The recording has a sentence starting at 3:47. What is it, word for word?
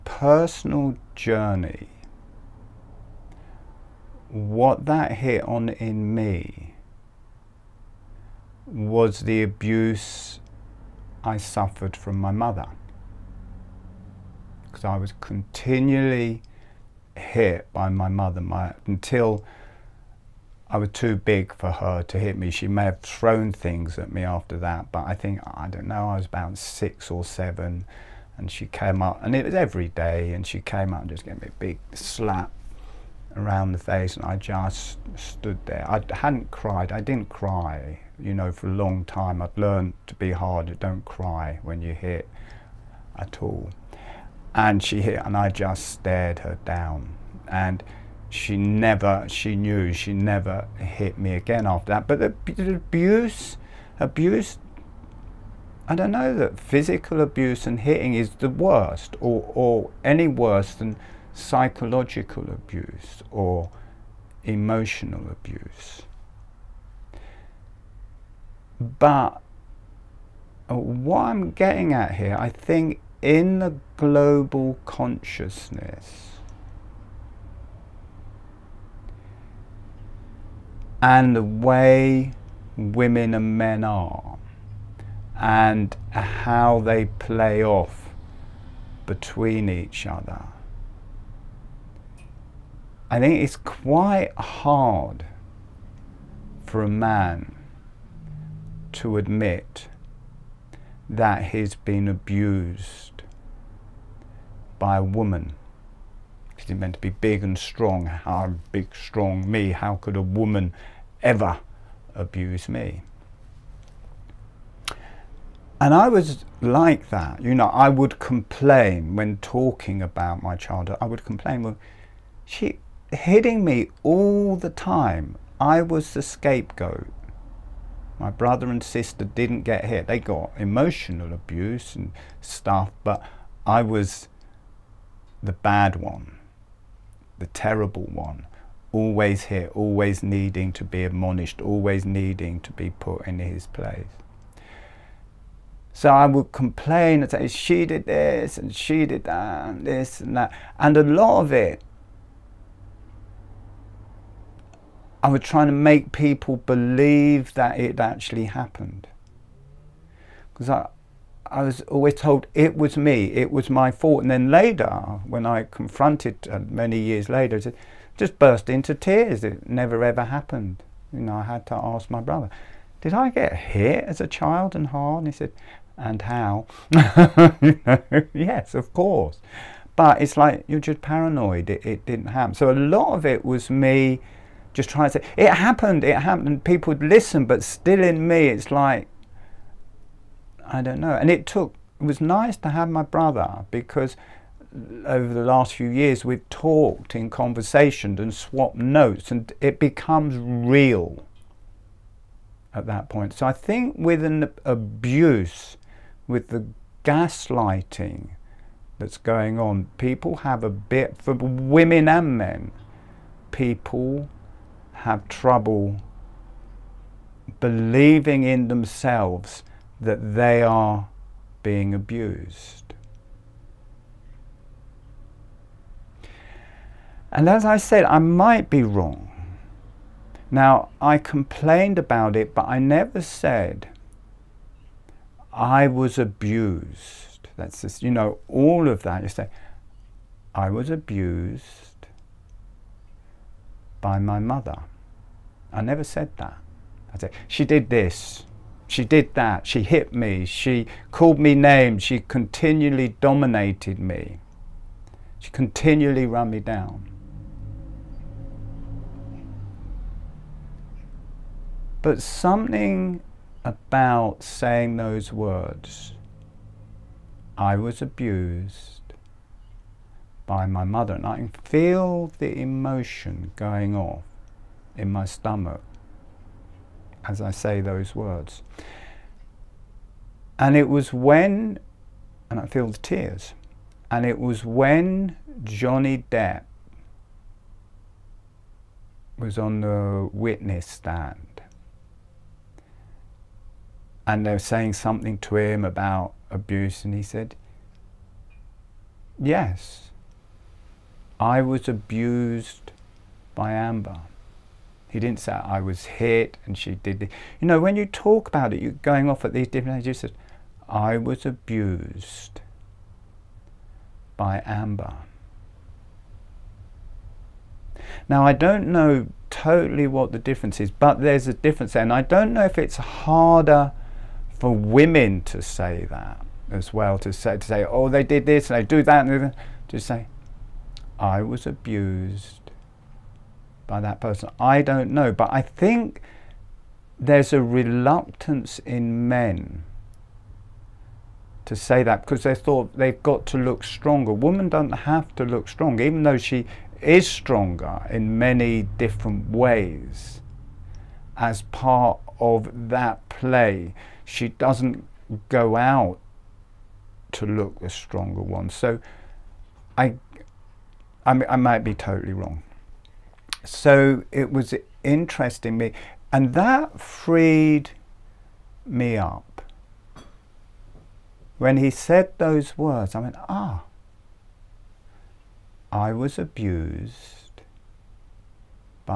And as I said, I might be wrong.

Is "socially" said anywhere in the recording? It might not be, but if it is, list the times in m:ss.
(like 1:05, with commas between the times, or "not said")
not said.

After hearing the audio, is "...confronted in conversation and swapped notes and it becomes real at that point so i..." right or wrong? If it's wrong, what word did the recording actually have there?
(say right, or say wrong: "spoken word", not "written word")
wrong: "talked", not "confronted".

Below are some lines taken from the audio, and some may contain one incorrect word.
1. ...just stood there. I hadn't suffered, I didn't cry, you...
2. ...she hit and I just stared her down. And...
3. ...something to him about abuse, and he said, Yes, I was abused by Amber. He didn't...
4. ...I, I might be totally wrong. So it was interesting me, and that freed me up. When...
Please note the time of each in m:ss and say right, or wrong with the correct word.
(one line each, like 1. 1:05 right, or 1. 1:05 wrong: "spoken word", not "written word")
1. 0:34 wrong: "cried", not "suffered"
2. 0:44 right
3. 4:54 right
4. 6:01 right.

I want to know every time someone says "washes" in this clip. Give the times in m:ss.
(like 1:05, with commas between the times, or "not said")
not said.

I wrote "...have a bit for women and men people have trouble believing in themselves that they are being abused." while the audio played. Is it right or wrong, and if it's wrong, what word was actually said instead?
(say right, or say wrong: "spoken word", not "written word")
right.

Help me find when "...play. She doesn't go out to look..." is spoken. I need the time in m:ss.
5:53.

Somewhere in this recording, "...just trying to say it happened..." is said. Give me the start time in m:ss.
3:04.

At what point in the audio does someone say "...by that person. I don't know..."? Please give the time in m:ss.
5:33.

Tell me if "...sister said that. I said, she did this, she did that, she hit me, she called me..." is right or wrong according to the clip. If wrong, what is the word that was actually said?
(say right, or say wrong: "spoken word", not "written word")
wrong: "never", not "sister".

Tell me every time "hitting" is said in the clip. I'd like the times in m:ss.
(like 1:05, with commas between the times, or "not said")
0:57, 2:03.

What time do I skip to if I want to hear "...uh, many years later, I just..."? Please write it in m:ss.
2:46.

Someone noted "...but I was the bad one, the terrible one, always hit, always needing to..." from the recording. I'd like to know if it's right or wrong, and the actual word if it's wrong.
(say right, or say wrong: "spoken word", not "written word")
right.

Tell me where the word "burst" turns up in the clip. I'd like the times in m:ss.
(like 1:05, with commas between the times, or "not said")
2:48.